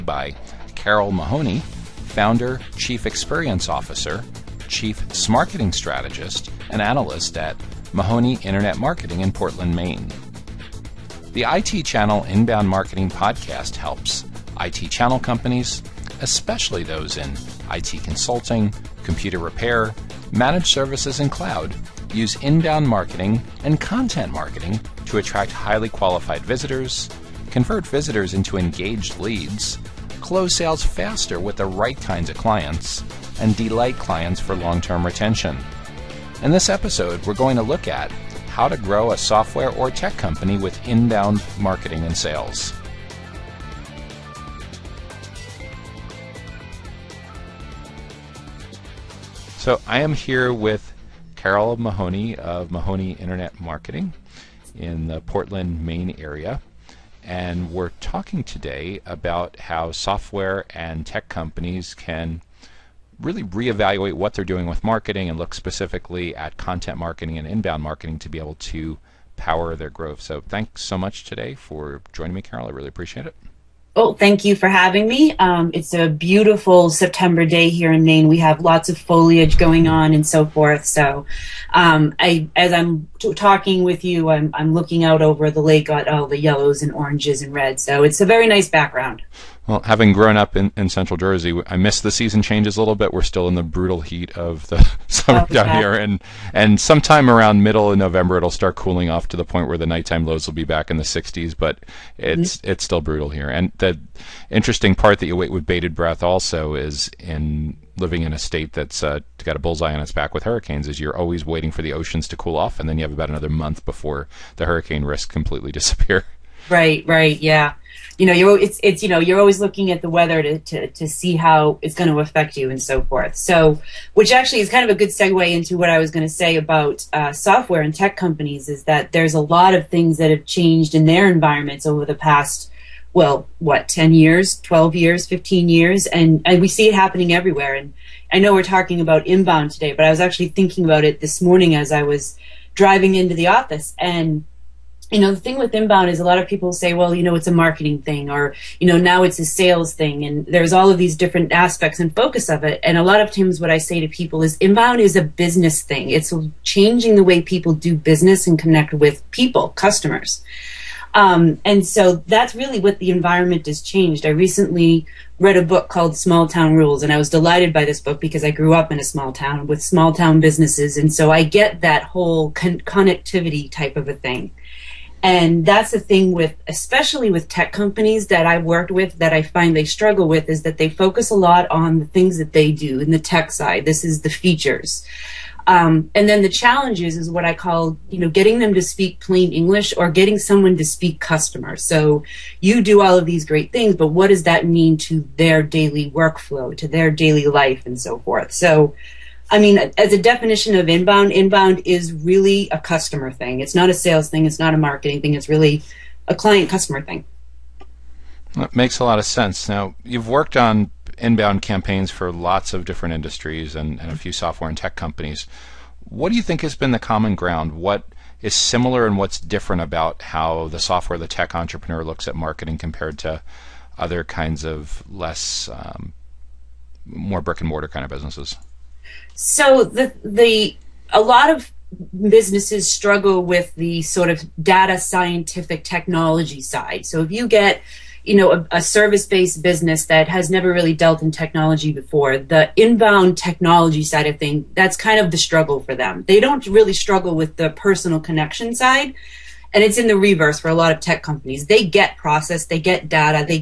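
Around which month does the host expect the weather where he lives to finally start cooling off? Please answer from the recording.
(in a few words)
November.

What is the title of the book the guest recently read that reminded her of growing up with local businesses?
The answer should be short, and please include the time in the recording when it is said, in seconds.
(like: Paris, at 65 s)
Small Town Rules, at 166 s.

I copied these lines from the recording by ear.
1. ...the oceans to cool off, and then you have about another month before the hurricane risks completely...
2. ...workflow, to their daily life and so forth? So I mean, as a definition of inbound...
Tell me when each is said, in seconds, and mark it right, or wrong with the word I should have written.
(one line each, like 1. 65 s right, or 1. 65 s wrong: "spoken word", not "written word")
1. 111 s right
2. 196 s right.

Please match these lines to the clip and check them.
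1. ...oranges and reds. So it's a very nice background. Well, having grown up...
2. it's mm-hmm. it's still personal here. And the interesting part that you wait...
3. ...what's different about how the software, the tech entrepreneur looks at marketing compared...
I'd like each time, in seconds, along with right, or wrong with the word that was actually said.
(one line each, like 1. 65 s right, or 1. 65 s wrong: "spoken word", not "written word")
1. 86 s right
2. 102 s wrong: "brutal", not "personal"
3. 219 s right.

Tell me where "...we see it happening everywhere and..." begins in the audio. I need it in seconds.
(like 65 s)
136 s.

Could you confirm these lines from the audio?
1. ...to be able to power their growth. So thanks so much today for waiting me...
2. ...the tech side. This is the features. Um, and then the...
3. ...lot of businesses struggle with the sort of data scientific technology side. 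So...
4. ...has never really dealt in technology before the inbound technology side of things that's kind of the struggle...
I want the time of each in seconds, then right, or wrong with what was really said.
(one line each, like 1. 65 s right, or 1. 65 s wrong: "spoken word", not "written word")
1. 68 s wrong: "joining", not "waiting"
2. 183 s right
3. 231 s right
4. 240 s right.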